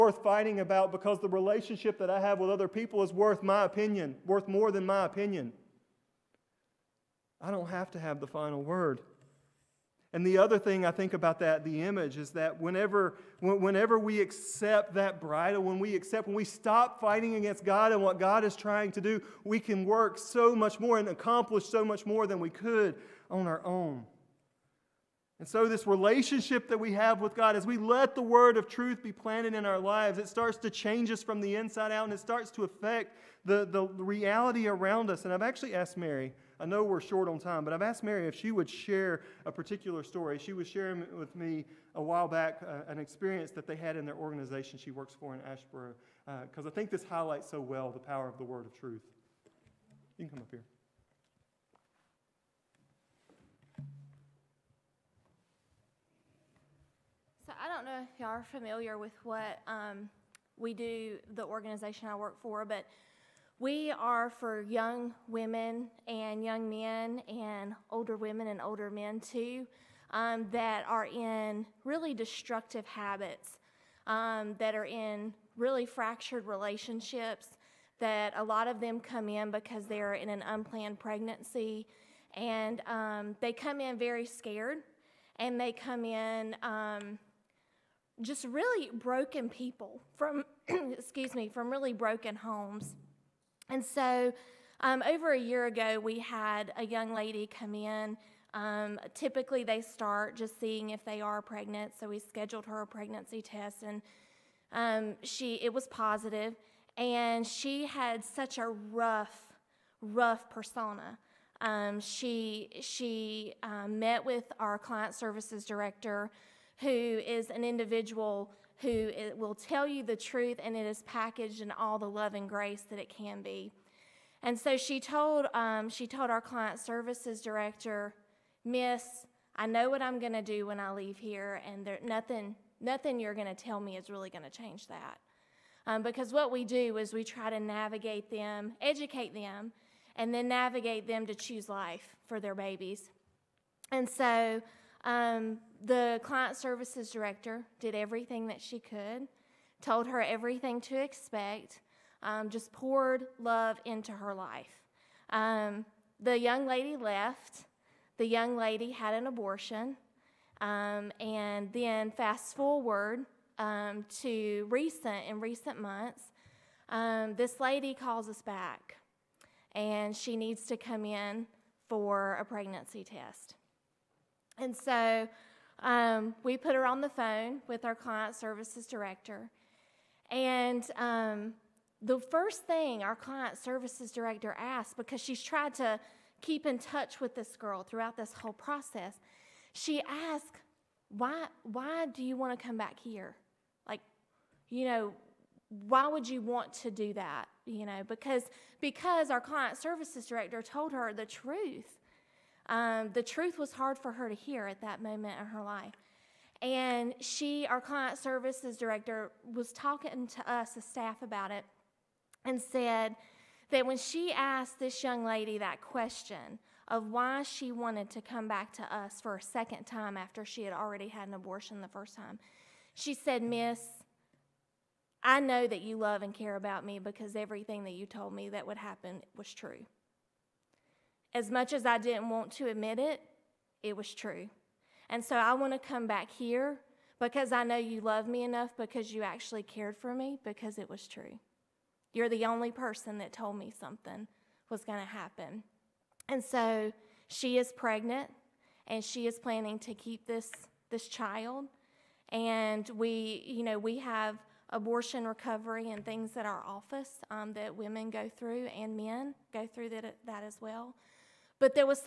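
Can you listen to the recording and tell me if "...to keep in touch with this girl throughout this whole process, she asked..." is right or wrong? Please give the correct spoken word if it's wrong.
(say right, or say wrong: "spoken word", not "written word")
right.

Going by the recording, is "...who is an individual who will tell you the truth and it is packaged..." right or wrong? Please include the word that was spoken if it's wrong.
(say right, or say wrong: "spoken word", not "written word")
right.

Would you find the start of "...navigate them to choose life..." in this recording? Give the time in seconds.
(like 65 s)
140 s.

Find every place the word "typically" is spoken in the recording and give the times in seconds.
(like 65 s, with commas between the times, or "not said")
99 s.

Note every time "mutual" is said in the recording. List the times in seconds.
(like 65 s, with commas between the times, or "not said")
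not said.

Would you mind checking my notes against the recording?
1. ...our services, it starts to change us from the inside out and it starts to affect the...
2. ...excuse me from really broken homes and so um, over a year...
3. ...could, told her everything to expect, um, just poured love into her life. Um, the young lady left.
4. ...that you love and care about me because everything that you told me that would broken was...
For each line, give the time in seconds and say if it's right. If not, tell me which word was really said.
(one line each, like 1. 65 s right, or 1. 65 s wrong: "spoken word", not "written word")
1. 29 s wrong: "lives", not "services"
2. 90 s right
3. 148 s right
4. 225 s wrong: "happen", not "broken".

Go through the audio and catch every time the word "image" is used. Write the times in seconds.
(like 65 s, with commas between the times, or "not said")
11 s.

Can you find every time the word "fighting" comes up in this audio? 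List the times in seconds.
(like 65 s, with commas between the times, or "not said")
0 s, 17 s.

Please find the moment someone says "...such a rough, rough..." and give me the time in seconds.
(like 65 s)
108 s.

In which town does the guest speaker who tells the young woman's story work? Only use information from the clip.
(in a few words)
Asheboro.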